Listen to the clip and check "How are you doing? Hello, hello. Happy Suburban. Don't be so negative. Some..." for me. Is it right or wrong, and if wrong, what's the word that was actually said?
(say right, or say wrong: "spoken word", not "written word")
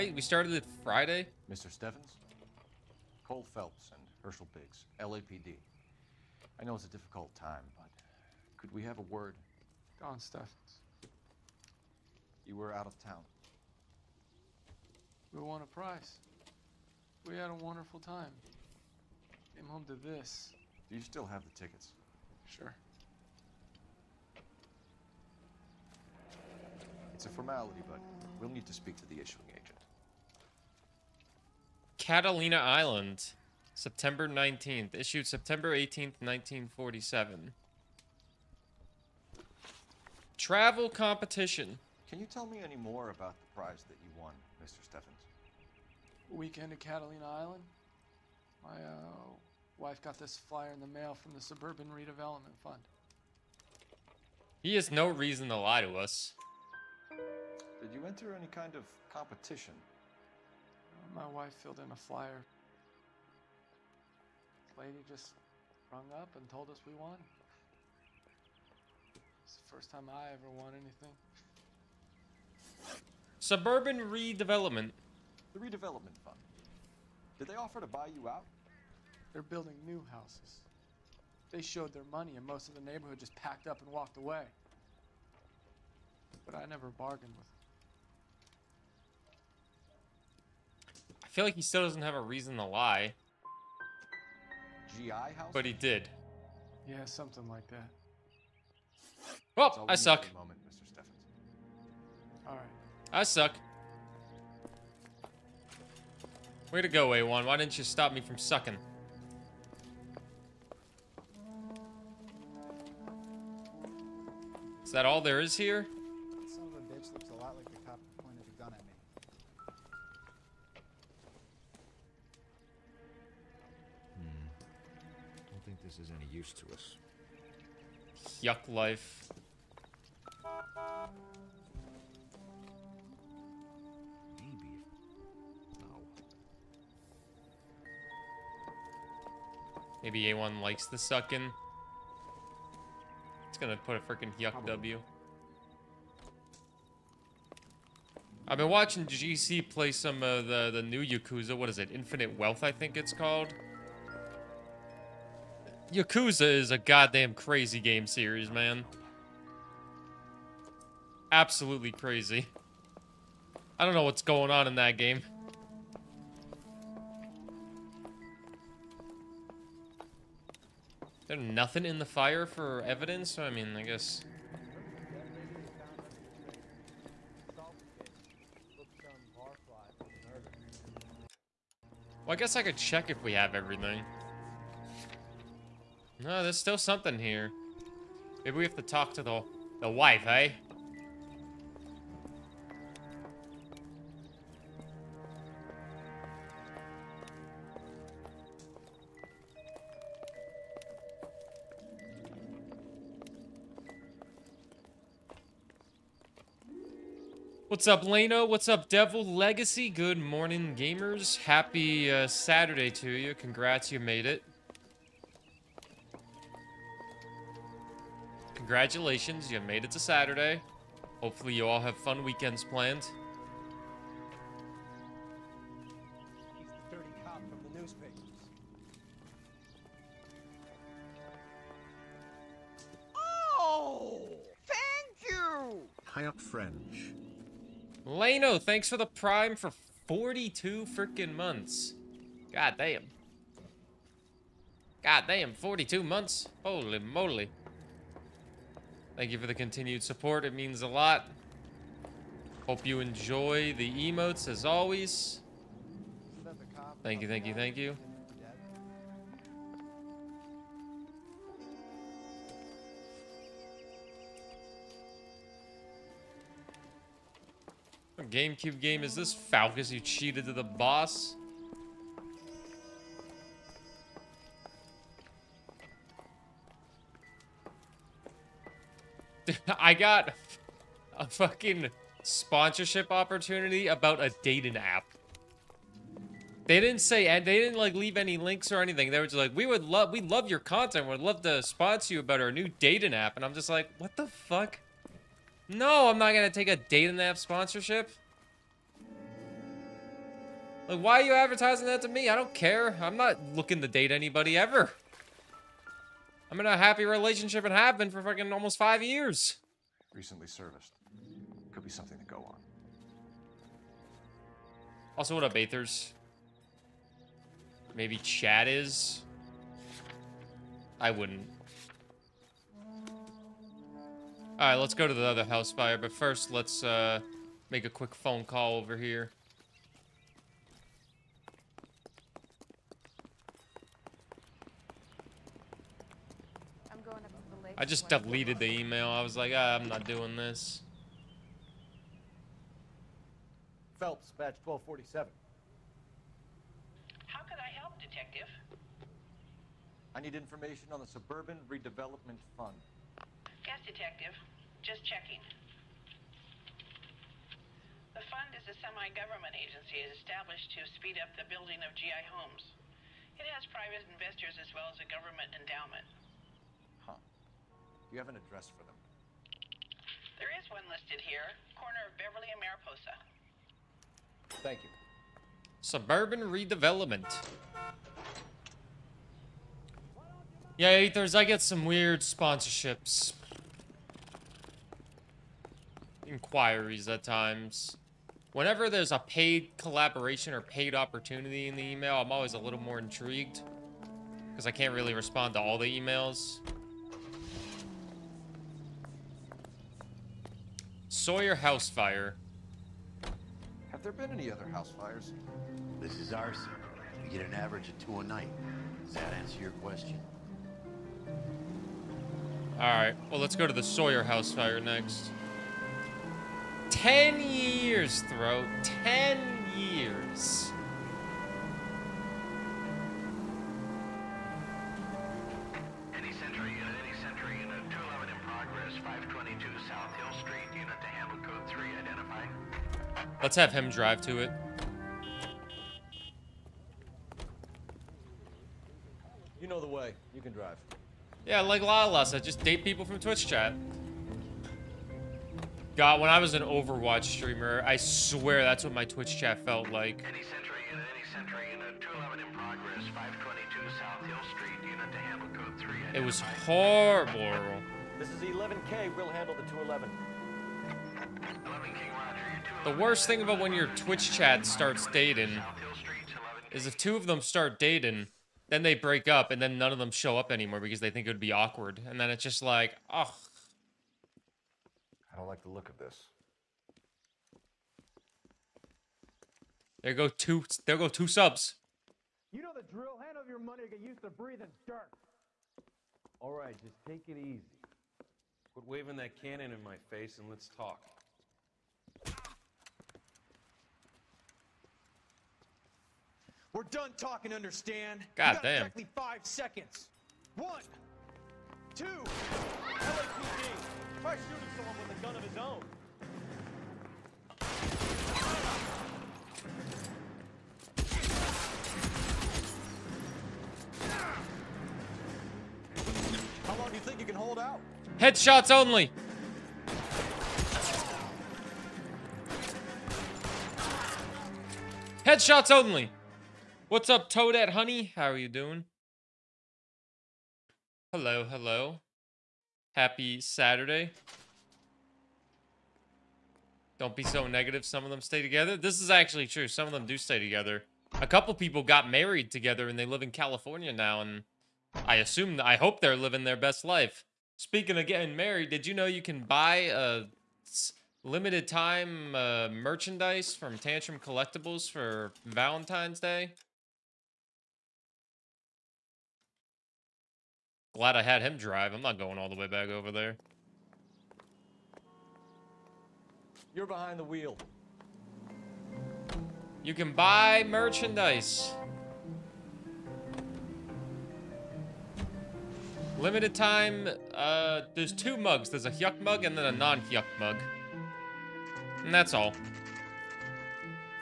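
wrong: "Saturday", not "Suburban".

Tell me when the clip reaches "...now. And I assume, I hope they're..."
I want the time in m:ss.
9:03.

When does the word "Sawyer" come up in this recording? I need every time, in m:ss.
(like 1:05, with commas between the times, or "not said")
6:41, 6:53.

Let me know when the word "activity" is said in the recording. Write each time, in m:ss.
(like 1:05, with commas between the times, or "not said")
not said.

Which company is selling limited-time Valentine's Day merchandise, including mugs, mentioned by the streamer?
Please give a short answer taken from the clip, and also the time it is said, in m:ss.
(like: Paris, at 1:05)
Tantrum Collectibles, at 9:13.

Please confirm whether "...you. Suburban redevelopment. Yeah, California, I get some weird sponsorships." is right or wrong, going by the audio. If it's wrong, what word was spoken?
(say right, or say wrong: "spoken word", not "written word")
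wrong: "Ethers", not "California".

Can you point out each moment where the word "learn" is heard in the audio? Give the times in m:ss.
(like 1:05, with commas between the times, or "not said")
not said.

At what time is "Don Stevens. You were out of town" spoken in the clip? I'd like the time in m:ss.
0:09.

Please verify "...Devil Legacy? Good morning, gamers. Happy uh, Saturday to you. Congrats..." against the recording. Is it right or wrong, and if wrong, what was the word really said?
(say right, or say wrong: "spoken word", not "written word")
right.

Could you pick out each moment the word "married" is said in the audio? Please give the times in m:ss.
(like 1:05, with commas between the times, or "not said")
9:02, 9:08.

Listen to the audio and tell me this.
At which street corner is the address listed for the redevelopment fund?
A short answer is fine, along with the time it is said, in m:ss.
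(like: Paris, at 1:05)
Beverly and Mariposa, at 6:11.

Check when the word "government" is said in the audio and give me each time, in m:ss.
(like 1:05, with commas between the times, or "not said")
5:58, 6:05.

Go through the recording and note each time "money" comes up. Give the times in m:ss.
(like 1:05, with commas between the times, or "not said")
1:22, 8:03.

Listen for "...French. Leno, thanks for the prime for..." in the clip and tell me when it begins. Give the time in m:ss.
3:56.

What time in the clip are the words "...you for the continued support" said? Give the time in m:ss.
4:09.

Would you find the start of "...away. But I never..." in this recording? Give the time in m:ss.
1:24.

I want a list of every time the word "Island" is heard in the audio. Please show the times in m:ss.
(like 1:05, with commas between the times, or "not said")
0:32, 0:47.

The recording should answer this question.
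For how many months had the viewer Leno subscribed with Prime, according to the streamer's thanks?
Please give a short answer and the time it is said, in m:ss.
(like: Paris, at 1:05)
42, at 4:05.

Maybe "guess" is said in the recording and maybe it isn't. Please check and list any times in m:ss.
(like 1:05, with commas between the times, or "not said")
2:53, 3:02.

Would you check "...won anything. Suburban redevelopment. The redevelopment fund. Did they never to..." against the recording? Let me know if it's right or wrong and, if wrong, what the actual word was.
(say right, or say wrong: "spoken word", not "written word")
wrong: "offer", not "never".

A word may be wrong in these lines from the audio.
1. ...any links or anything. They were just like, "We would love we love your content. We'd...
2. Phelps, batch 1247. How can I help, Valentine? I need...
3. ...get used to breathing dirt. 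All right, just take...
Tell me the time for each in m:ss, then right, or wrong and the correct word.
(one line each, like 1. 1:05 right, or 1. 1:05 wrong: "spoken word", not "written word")
1. 4:48 right
2. 5:44 wrong: "Detective", not "Valentine"
3. 8:03 right.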